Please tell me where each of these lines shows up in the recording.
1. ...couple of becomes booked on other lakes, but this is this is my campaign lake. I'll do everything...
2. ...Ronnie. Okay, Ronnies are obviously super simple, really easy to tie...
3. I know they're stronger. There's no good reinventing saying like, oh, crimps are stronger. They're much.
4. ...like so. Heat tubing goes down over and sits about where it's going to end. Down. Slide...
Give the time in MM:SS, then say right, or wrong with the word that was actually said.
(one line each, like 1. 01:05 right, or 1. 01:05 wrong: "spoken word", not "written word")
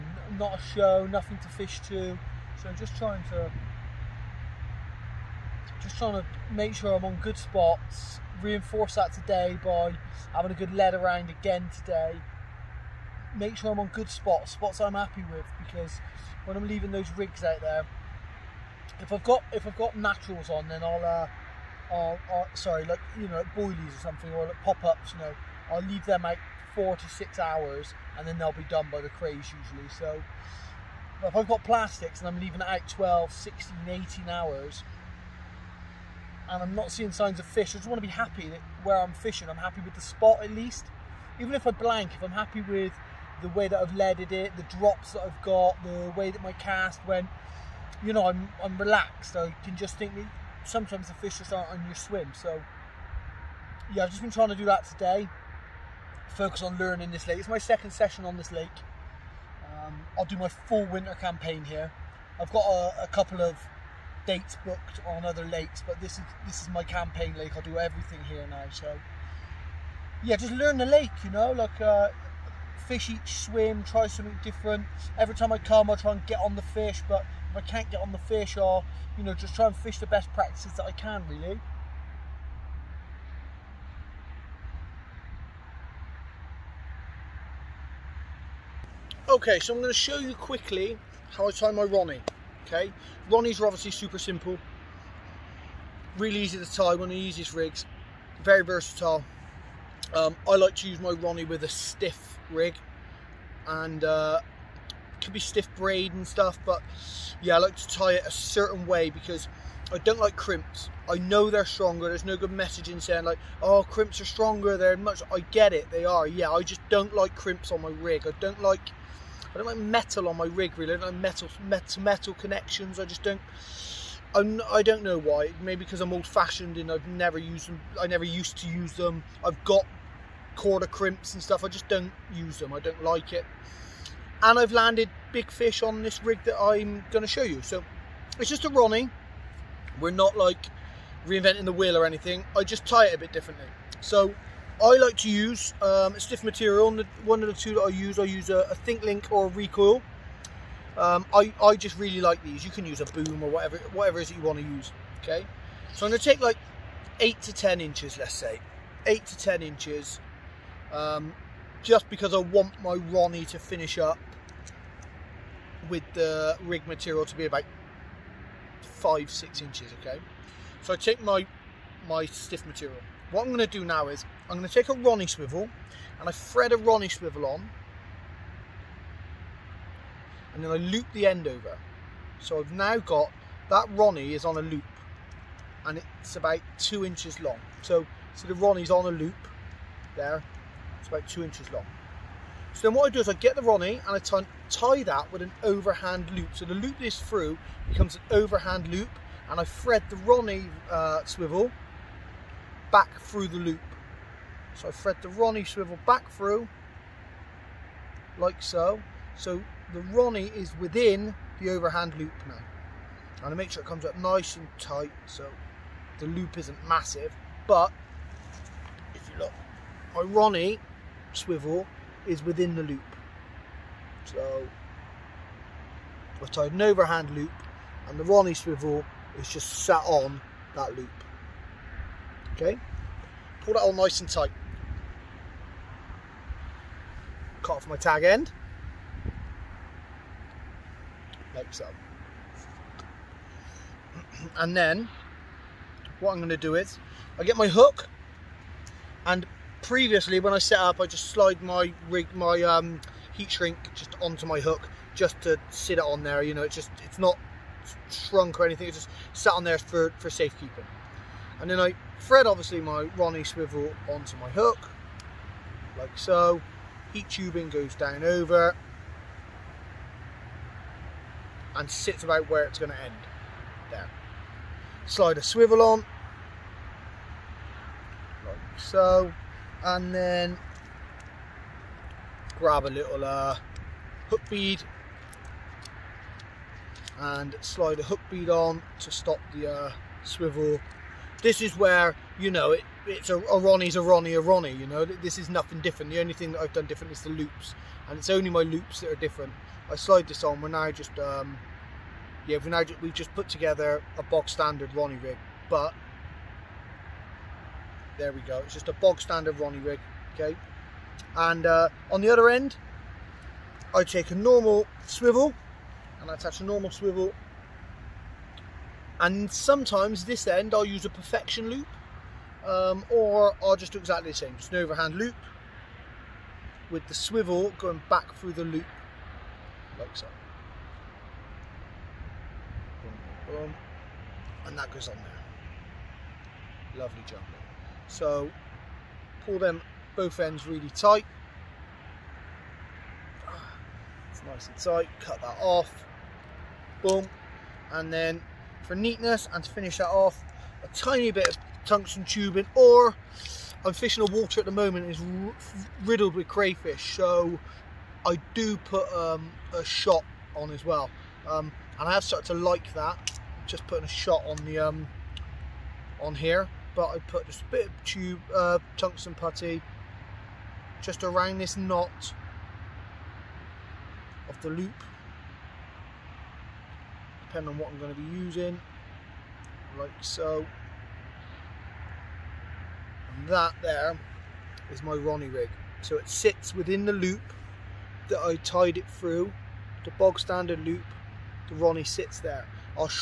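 1. 01:03 wrong: "dates", not "becomes"
2. 01:31 right
3. 01:51 wrong: "messaging", not "reinventing"
4. 04:25 right.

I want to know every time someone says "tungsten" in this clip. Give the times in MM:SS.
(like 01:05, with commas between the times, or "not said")
05:51, 06:08.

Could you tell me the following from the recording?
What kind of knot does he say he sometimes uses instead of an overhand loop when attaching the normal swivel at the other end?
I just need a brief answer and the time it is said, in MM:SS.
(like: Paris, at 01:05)
perfection loop, at 05:21.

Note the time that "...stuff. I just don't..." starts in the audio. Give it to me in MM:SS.
02:11.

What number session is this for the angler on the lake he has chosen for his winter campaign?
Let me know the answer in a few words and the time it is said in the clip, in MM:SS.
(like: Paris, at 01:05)
second, at 00:57.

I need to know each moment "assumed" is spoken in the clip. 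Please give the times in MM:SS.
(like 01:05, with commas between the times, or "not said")
not said.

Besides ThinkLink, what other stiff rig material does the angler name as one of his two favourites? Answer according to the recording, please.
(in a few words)
Recoil.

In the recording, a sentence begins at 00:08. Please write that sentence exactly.
Reinforce that today by having a good lead around again today.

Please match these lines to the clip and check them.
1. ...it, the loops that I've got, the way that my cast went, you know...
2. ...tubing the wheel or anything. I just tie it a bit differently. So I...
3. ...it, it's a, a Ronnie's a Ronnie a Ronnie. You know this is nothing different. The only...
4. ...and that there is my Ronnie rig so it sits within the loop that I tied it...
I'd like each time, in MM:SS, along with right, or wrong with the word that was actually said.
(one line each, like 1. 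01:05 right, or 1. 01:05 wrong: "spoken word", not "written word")
1. 00:44 wrong: "drops", not "loops"
2. 02:21 wrong: "reinventing", not "tubing"
3. 04:52 right
4. 06:23 right.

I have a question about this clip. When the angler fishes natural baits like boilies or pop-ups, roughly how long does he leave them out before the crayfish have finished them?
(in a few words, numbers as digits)
4 to 6 hours.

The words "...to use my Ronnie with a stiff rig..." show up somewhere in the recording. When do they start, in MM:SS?
01:40.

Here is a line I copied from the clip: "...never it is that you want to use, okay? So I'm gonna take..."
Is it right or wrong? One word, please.
wrong.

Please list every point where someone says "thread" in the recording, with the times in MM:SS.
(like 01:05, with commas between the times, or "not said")
02:56, 03:19, 03:24, 04:22.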